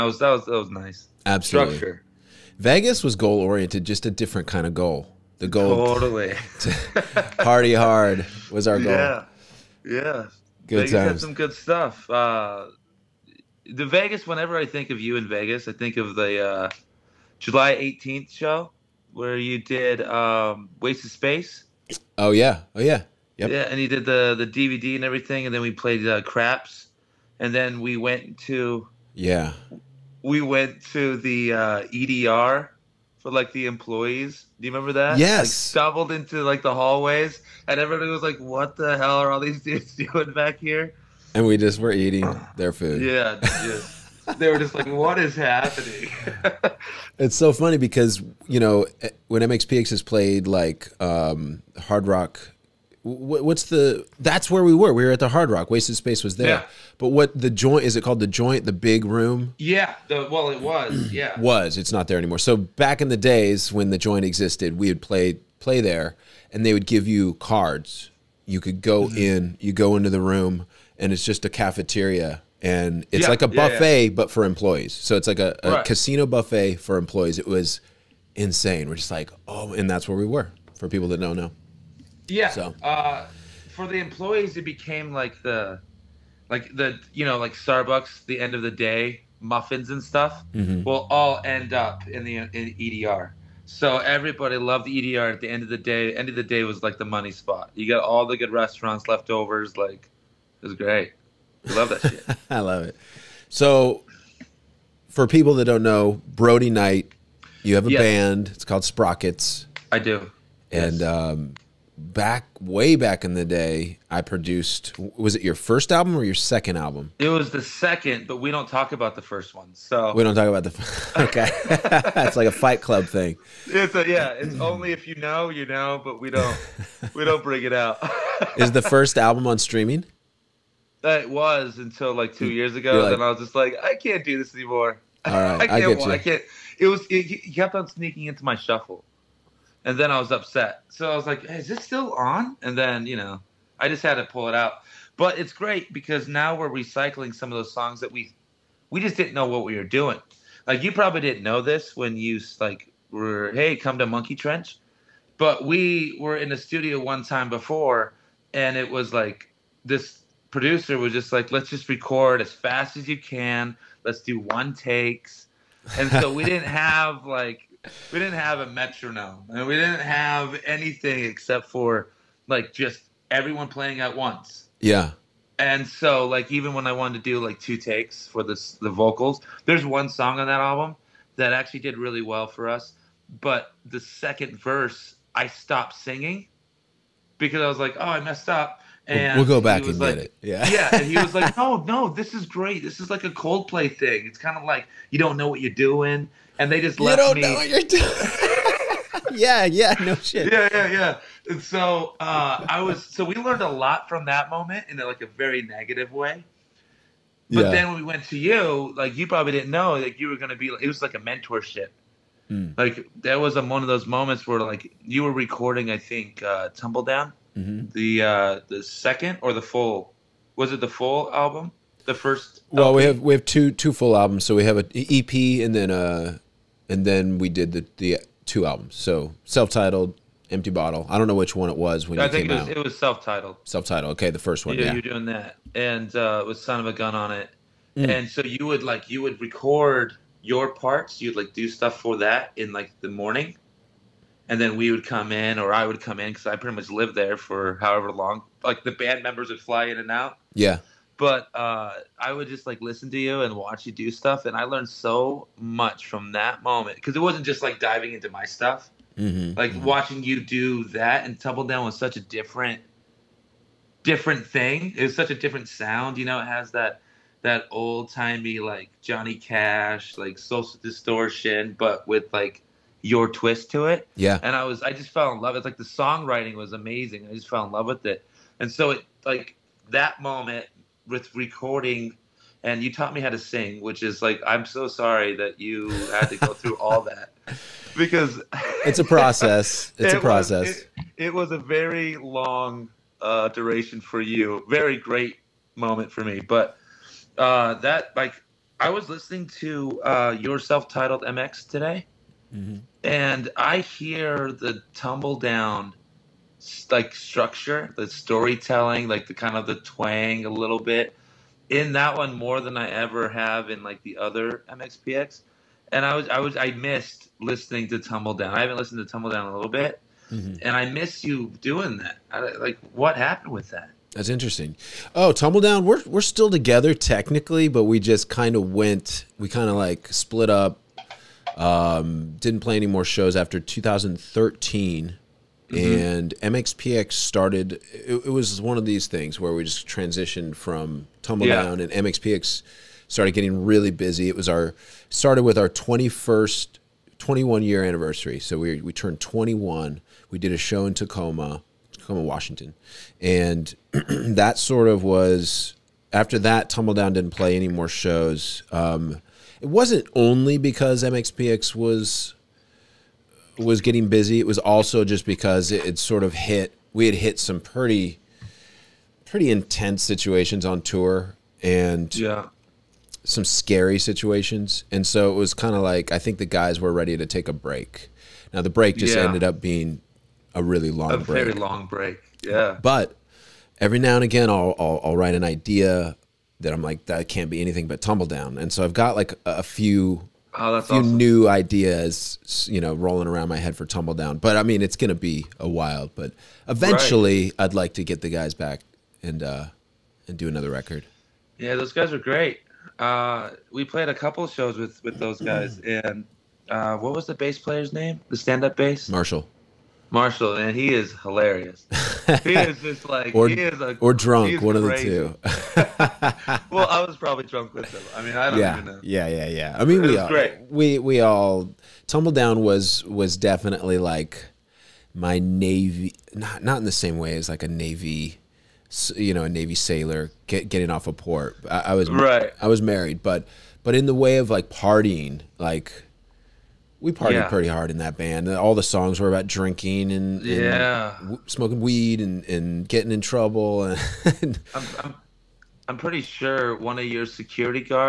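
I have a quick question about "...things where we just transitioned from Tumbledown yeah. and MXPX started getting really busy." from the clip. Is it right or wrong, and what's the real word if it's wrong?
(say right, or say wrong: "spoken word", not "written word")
right.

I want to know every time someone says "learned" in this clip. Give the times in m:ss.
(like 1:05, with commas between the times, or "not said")
3:23, 4:14.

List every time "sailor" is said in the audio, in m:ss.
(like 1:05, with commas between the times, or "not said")
7:09.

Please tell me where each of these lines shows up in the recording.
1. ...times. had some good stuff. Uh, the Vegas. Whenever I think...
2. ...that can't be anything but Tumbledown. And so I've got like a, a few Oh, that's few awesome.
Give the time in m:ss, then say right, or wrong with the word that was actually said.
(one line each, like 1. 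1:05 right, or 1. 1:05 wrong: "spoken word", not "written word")
1. 0:10 right
2. 6:27 right.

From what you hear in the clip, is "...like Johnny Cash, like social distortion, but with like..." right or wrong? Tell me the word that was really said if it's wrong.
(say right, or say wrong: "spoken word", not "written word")
right.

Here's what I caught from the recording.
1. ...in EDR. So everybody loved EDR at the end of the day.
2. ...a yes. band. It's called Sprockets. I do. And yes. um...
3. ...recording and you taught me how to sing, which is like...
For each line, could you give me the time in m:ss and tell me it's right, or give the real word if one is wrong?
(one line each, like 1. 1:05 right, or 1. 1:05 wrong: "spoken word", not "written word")
1. 1:32 right
2. 1:47 right
3. 4:41 right.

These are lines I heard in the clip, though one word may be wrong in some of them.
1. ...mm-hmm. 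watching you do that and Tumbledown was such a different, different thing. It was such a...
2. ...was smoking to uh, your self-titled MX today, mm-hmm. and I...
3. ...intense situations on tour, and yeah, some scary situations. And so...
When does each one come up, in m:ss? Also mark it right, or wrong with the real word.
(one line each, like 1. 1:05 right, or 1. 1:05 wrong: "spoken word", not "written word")
1. 4:19 right
2. 4:58 wrong: "listening", not "smoking"
3. 6:09 right.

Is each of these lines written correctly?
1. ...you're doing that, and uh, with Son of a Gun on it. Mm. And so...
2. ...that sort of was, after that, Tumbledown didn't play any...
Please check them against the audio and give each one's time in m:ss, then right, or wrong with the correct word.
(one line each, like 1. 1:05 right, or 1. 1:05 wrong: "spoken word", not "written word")
1. 3:54 right
2. 5:53 right.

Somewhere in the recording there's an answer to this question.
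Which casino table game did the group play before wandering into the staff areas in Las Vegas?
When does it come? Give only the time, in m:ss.
0:26.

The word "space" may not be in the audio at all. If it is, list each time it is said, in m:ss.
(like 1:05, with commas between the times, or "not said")
0:21, 0:55.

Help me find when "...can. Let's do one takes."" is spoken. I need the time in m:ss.
2:43.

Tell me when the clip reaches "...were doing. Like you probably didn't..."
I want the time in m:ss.
2:29.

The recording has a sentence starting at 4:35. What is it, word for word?
It's like the songwriting was amazing.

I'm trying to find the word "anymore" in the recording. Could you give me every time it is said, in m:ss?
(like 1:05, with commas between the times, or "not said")
1:02, 2:14.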